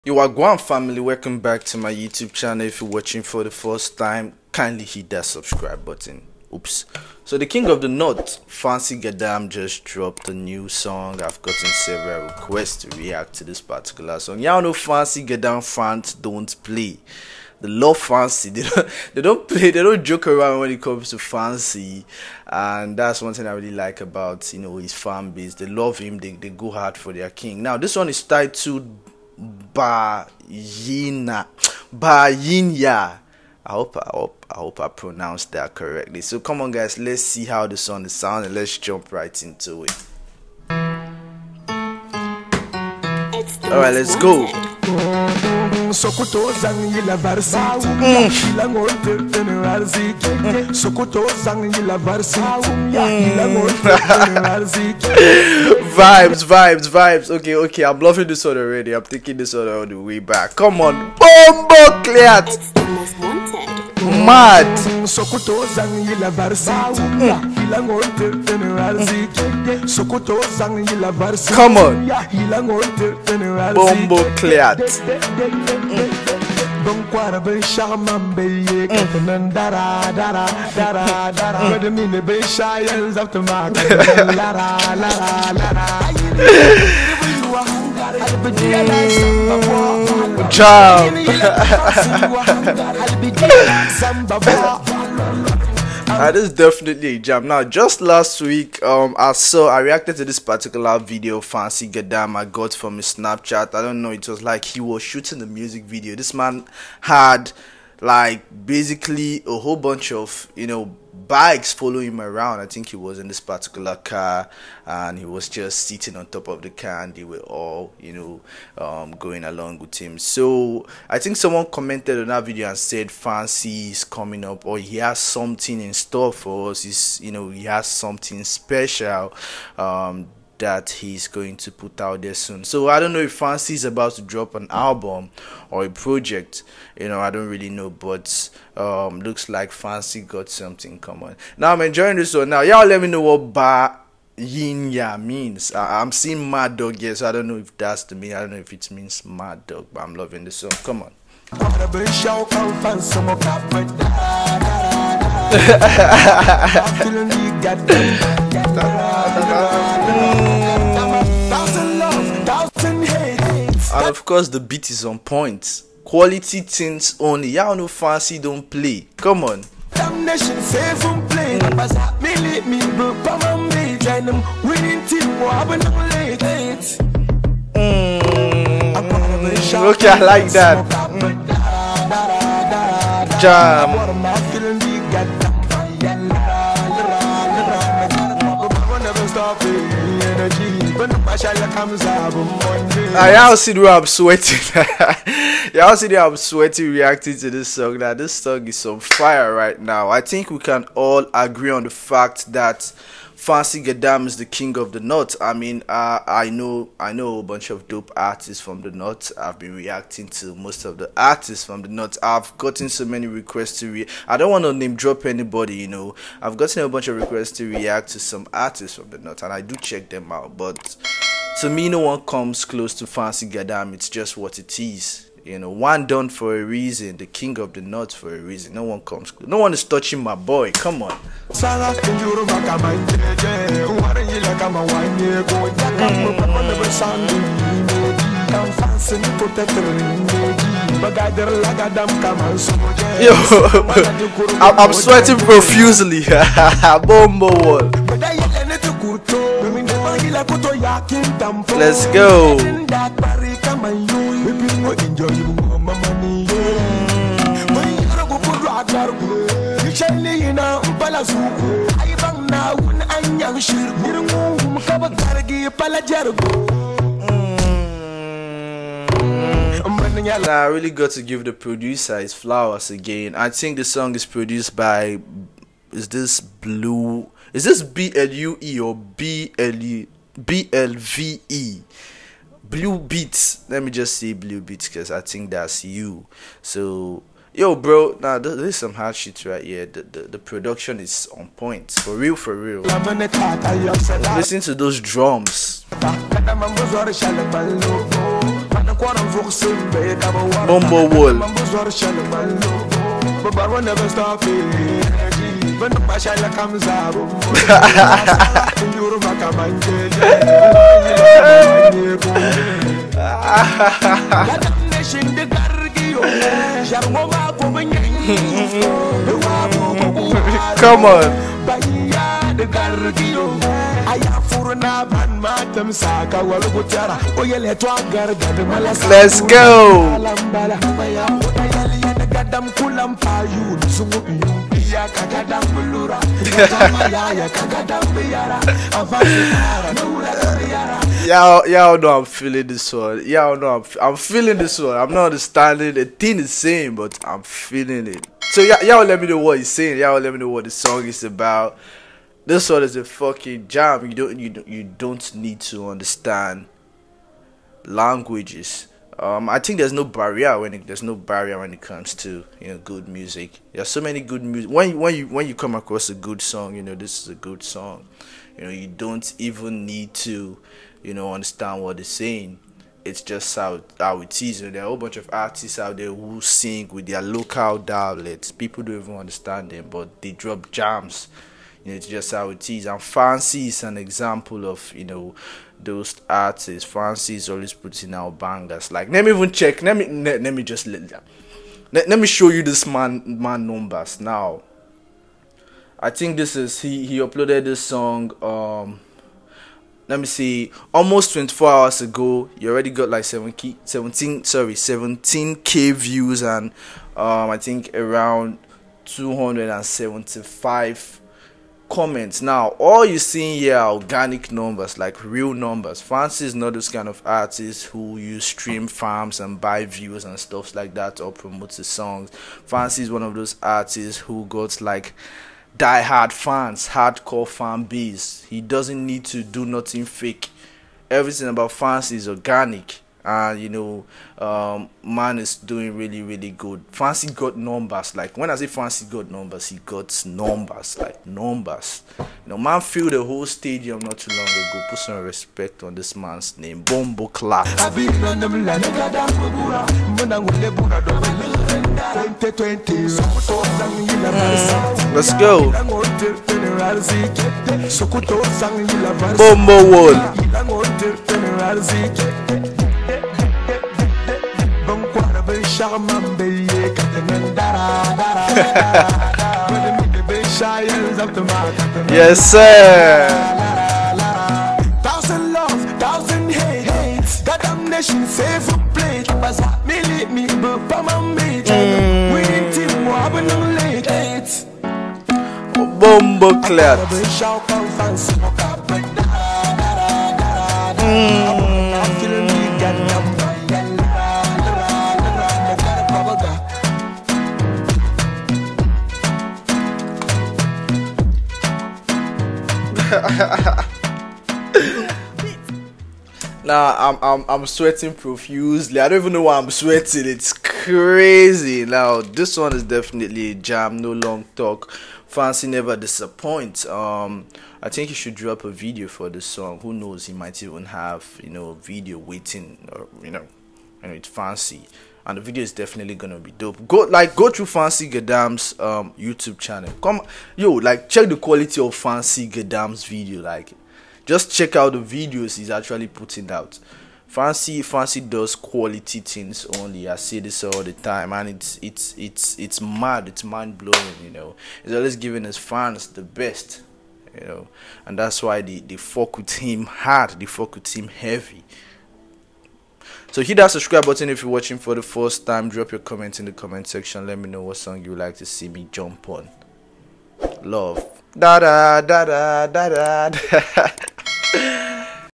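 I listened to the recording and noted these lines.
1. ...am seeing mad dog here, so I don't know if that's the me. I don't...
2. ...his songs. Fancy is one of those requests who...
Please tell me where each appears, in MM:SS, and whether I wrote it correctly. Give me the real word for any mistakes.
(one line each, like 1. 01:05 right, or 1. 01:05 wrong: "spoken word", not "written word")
1. 02:26 right
2. 07:01 wrong: "artists", not "requests".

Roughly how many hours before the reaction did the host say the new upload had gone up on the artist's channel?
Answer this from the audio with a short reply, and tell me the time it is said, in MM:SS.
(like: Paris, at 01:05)
24, at 06:41.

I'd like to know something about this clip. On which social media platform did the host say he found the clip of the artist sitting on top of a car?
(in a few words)
Snapchat.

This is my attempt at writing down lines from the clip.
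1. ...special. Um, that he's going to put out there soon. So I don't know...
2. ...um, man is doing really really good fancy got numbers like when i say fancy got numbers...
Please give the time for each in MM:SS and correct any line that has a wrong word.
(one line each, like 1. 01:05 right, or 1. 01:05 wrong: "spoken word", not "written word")
1. 02:08 right
2. 07:14 right.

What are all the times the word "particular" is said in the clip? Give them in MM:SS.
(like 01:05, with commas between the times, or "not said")
00:13, 01:40, 01:53.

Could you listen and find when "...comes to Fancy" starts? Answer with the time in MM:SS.
00:20.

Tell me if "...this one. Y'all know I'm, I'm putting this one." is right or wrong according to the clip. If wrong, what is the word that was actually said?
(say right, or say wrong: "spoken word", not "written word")
wrong: "feeling", not "putting".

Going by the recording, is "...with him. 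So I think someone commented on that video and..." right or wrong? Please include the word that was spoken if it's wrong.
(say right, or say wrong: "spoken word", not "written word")
right.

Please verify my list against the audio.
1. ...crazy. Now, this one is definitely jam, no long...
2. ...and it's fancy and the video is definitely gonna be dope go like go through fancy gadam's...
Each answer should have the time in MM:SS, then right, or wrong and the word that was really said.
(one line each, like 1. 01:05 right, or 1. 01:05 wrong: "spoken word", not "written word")
1. 08:30 right
2. 08:44 right.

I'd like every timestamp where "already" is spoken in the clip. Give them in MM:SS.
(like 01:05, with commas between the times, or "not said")
00:58, 06:42.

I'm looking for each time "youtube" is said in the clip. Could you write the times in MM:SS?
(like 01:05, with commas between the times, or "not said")
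00:01, 08:49.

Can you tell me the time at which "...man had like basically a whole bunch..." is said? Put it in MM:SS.
01:46.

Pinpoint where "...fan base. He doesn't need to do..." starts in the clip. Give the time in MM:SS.
07:07.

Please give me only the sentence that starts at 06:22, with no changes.
And Fancy is an example of, you know, those artists.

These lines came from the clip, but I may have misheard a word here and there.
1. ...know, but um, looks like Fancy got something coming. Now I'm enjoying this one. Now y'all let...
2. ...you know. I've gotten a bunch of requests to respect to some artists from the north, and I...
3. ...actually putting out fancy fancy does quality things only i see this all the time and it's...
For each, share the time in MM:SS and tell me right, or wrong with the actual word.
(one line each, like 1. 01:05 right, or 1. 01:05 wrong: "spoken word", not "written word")
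1. 02:17 right
2. 03:35 wrong: "react", not "respect"
3. 08:55 right.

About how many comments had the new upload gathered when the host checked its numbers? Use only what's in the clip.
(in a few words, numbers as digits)
275.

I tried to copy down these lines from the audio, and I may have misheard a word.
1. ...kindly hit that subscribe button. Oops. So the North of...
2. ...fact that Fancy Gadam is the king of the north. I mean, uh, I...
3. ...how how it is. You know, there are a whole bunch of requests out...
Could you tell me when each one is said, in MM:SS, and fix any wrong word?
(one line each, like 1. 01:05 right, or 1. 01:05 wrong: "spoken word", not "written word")
1. 00:04 wrong: "King", not "North"
2. 03:21 right
3. 06:13 wrong: "artists", not "requests".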